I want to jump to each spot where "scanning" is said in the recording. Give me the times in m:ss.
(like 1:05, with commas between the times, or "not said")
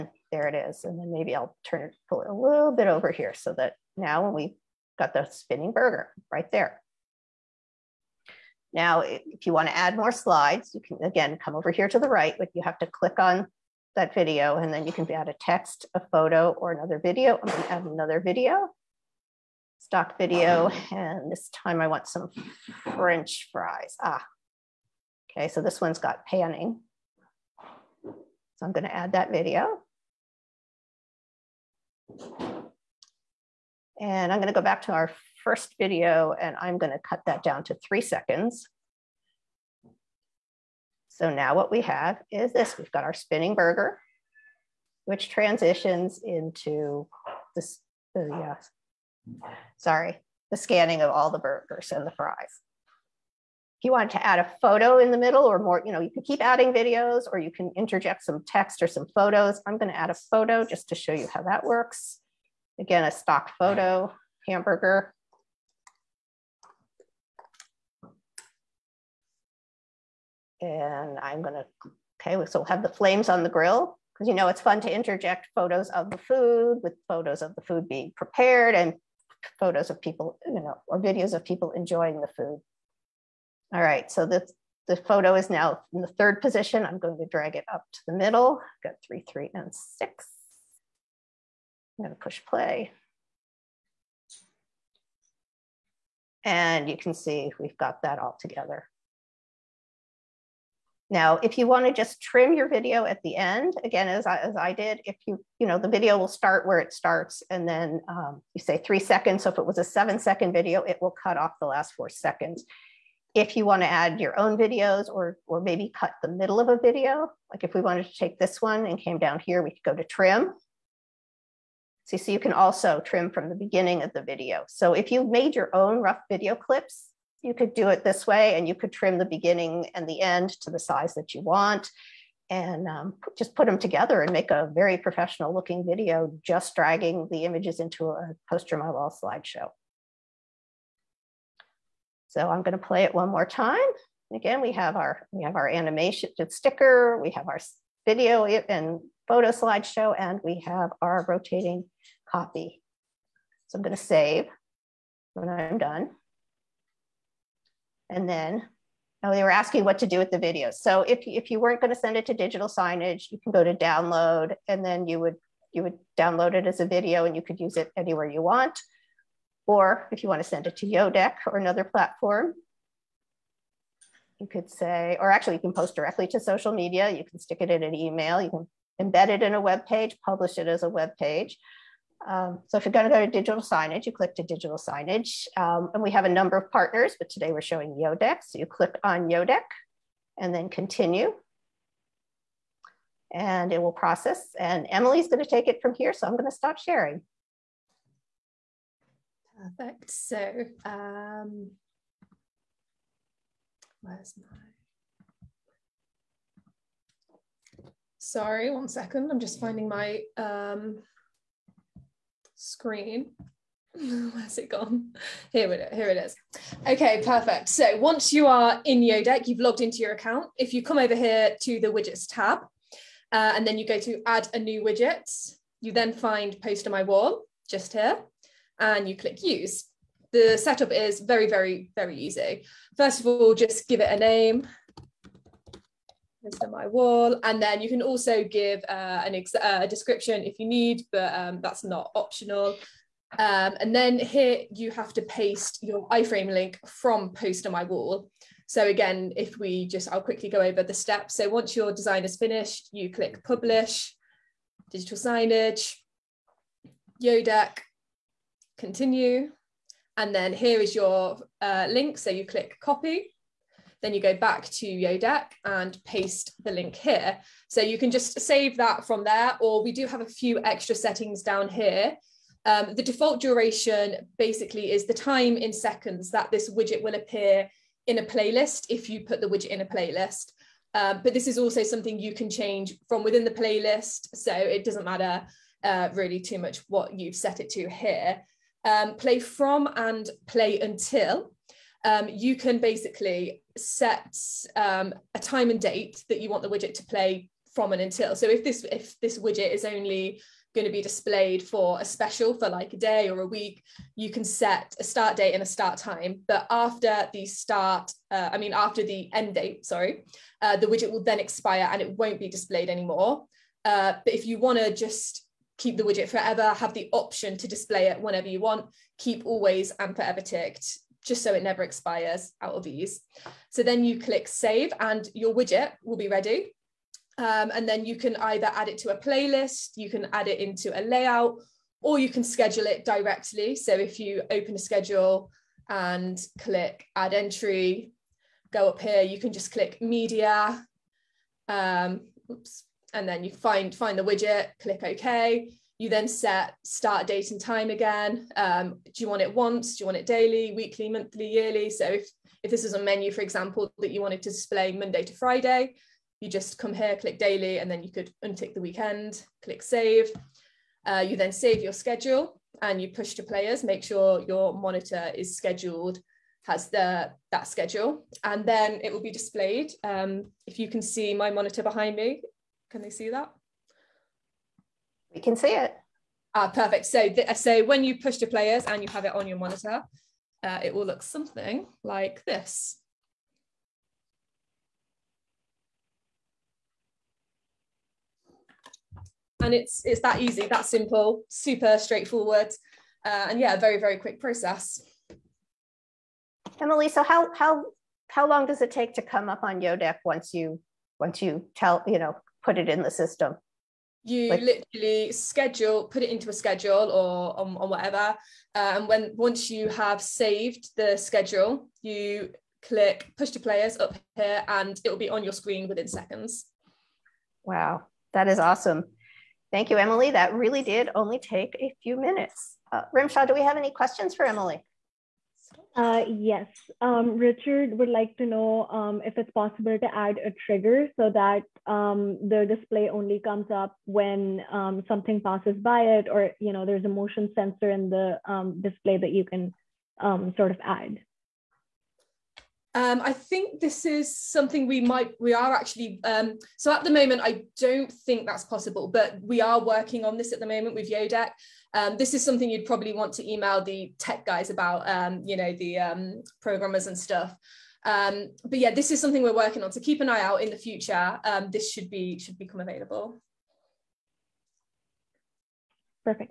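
0:50.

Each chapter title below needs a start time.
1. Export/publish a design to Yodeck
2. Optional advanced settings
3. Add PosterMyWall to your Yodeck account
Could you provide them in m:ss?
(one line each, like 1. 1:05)
1. 3:38
2. 3:49
3. 2:38.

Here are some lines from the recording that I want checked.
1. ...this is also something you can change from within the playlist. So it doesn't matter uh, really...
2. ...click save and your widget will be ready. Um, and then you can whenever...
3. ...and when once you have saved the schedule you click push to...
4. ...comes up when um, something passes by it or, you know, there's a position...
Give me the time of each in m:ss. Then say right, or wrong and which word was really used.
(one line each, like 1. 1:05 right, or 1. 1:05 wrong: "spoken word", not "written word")
1. 4:41 right
2. 5:24 wrong: "either", not "whenever"
3. 6:48 right
4. 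7:13 wrong: "motion", not "position".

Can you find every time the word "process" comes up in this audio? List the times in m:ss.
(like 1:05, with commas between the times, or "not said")
3:13, 6:34.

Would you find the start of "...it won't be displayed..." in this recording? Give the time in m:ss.
5:12.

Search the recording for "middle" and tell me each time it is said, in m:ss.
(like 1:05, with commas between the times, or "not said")
0:55, 1:28, 1:56.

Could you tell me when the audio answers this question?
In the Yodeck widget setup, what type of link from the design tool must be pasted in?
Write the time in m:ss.
4:06.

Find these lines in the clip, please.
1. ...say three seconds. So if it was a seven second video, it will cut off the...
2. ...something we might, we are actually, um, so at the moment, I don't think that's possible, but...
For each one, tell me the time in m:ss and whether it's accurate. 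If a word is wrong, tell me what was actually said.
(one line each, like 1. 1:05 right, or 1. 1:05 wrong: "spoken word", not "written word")
1. 1:48 right
2. 7:24 right.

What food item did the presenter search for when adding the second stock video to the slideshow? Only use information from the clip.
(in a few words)
French fries.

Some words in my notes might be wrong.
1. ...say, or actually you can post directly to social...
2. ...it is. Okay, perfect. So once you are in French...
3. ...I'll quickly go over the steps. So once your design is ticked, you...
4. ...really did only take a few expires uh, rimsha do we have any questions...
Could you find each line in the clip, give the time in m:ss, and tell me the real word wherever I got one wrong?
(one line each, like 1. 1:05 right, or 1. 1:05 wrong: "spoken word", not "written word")
1. 2:54 right
2. 3:36 wrong: "Yodeck", not "French"
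3. 4:10 wrong: "finished", not "ticked"
4. 7:00 wrong: "minutes", not "expires".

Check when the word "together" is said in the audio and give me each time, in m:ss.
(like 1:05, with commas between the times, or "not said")
1:38, 2:13.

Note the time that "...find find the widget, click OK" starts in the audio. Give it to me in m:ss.
5:43.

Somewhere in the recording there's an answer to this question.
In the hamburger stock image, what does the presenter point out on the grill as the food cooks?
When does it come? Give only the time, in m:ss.
1:12.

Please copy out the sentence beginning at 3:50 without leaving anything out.
The setup is very, very, very easy.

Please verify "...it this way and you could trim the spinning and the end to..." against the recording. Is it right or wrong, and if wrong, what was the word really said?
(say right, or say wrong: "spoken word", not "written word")
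wrong: "beginning", not "spinning".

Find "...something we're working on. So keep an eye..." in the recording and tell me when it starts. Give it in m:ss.
7:39.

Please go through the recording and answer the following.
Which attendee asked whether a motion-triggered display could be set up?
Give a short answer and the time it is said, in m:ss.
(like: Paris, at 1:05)
Richard, at 7:07.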